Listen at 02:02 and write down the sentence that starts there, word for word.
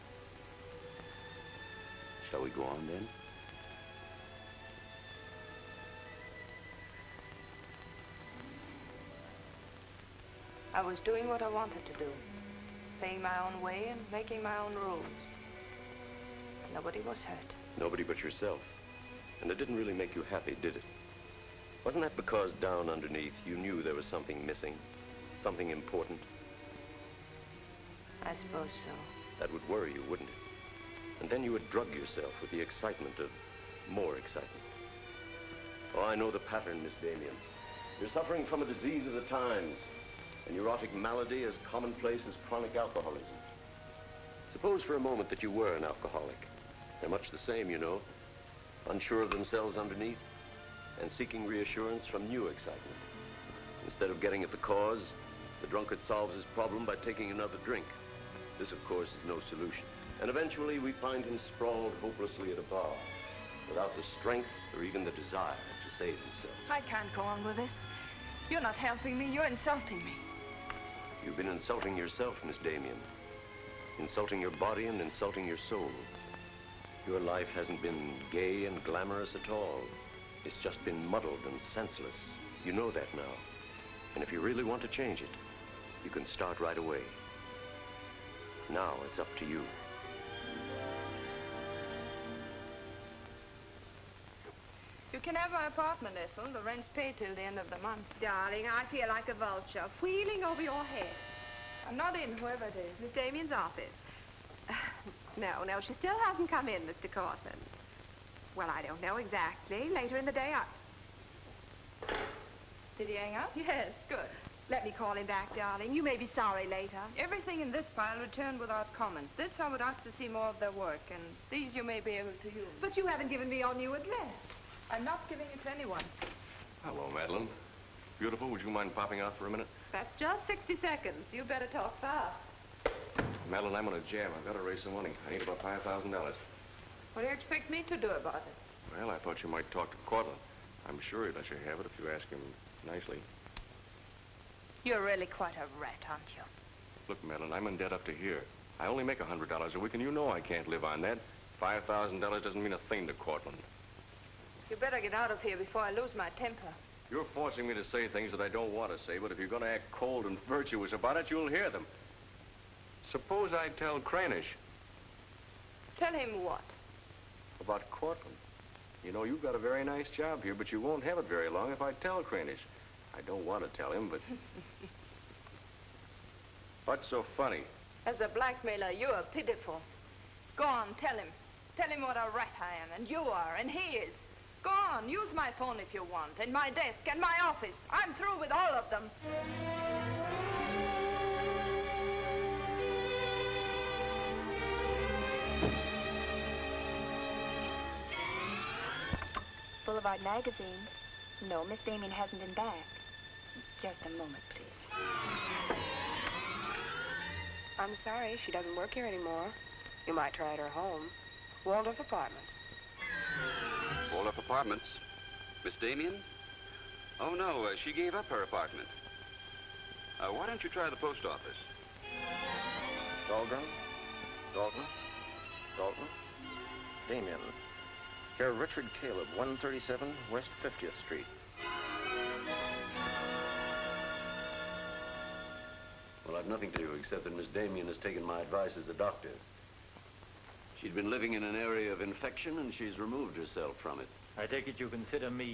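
But you haven't given me your new address.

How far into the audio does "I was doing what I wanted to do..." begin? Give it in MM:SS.
00:10.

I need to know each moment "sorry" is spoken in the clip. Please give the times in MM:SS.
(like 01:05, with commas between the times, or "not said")
01:56, 03:28.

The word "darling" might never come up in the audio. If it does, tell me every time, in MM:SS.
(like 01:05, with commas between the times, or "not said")
01:38, 01:55.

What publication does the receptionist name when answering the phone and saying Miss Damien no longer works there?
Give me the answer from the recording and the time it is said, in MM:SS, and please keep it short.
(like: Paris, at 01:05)
Boulevard Magazine, at 03:19.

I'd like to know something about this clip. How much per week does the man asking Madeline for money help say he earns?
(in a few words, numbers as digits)
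$100.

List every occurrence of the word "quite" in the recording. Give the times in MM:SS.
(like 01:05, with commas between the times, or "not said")
02:25.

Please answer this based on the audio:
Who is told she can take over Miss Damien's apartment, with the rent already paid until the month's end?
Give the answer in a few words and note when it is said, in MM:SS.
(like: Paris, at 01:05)
Ethel, at 01:36.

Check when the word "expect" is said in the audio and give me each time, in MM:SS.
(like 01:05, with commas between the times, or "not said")
02:17.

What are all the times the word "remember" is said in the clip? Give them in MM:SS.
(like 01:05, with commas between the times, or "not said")
not said.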